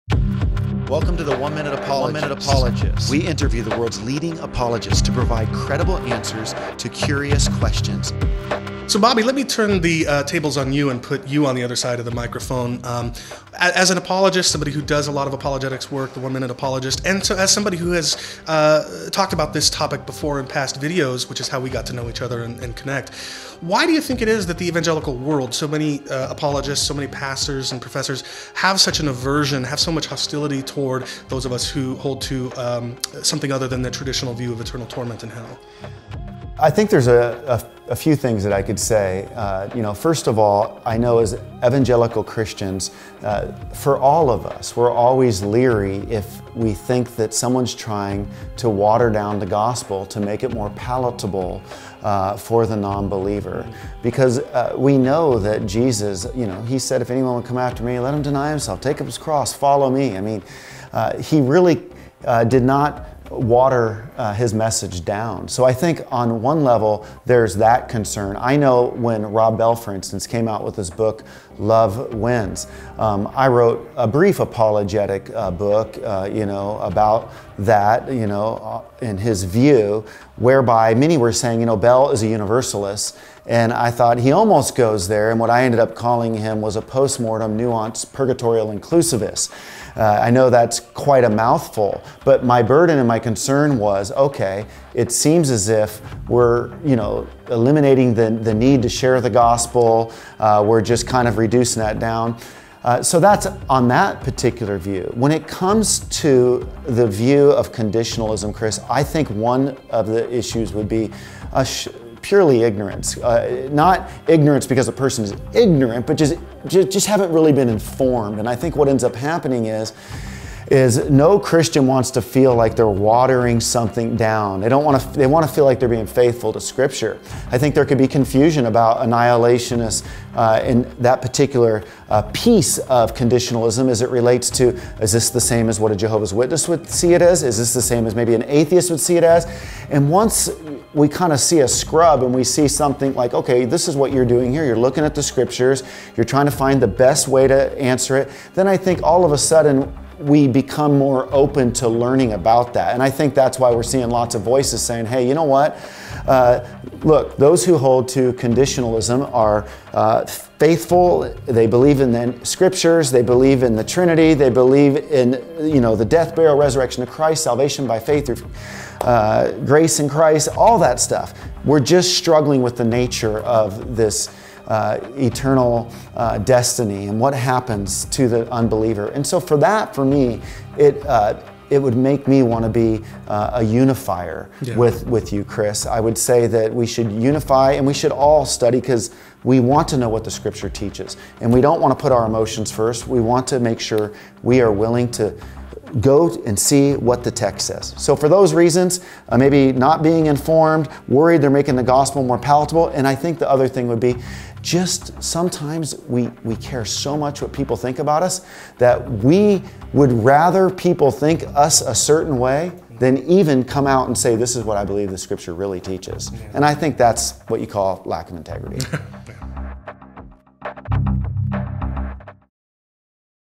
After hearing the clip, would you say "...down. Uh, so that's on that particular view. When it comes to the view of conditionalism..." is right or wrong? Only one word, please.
right.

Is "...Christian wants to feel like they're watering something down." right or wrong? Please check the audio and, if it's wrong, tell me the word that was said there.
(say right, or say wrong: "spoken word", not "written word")
right.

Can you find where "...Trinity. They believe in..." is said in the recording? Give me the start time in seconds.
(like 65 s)
163 s.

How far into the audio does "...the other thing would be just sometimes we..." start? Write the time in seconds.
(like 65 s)
203 s.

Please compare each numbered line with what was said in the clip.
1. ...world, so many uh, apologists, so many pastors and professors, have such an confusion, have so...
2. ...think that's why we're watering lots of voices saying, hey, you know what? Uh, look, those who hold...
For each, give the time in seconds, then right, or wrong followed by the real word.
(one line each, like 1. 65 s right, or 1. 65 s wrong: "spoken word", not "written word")
1. 25 s wrong: "aversion", not "confusion"
2. 153 s wrong: "seeing", not "watering".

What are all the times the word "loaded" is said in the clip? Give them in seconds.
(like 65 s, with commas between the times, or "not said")
not said.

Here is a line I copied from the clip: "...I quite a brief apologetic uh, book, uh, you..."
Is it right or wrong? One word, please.
wrong.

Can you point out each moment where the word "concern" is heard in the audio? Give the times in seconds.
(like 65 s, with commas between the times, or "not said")
67 s, 93 s.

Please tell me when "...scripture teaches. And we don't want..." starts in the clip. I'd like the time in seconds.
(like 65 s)
190 s.